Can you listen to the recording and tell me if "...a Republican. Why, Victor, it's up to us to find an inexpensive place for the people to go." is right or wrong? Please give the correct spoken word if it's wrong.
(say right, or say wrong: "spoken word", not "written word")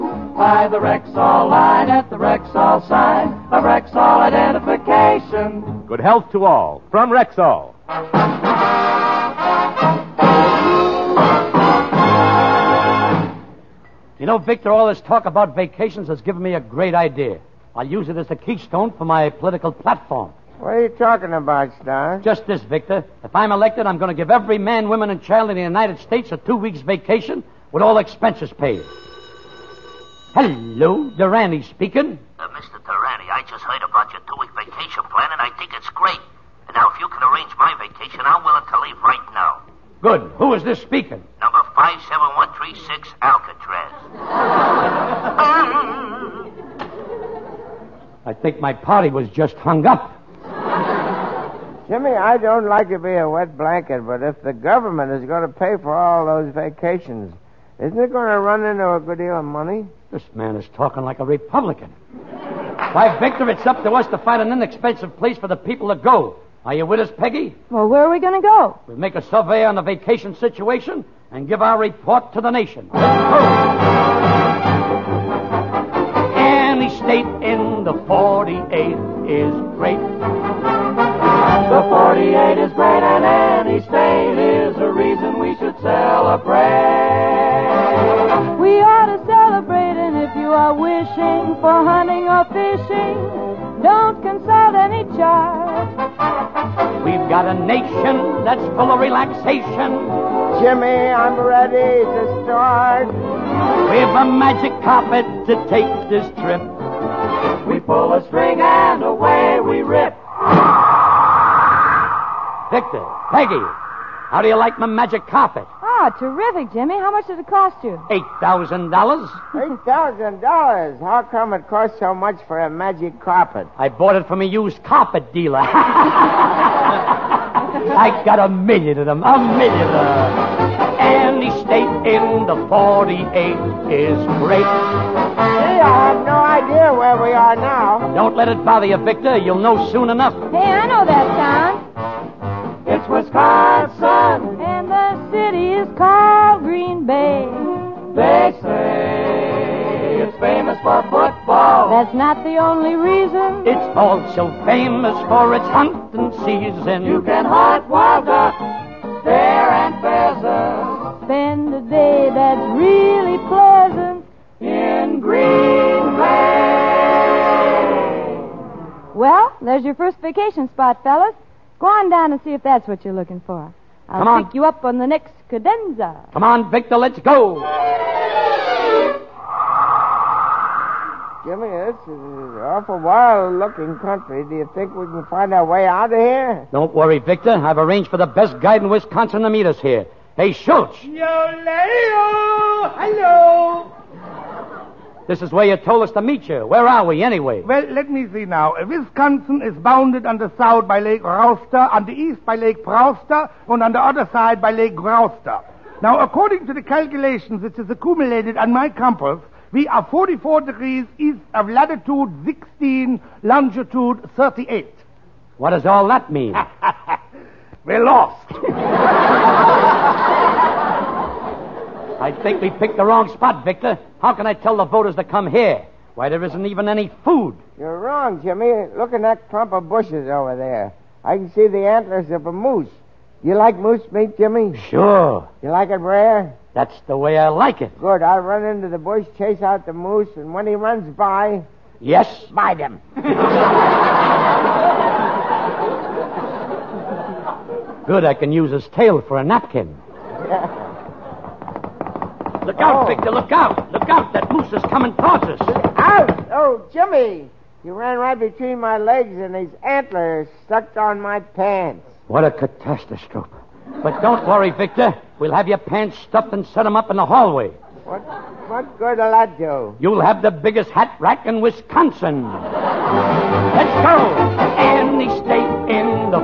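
right.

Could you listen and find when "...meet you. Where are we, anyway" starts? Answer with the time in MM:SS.
03:16.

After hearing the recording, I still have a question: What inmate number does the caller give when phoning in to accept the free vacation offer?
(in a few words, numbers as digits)
57136.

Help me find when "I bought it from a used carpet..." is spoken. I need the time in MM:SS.
02:03.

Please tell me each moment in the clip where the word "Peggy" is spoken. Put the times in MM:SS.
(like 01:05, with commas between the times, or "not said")
01:07, 01:53.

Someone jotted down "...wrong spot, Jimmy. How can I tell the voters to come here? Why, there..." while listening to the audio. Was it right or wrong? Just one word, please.
wrong.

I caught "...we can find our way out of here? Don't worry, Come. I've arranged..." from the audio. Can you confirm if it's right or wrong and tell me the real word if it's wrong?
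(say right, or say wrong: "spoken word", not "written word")
wrong: "Victor", not "Come".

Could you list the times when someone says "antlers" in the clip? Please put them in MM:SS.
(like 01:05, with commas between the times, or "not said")
03:51, 04:19.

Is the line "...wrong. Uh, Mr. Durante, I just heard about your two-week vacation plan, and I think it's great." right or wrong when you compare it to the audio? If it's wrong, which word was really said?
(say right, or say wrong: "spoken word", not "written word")
wrong: "speaking", not "wrong".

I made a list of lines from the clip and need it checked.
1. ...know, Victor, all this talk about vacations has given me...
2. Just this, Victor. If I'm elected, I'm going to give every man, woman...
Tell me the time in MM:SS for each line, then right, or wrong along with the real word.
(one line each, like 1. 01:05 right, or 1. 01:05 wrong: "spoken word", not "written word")
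1. 00:14 right
2. 00:22 right.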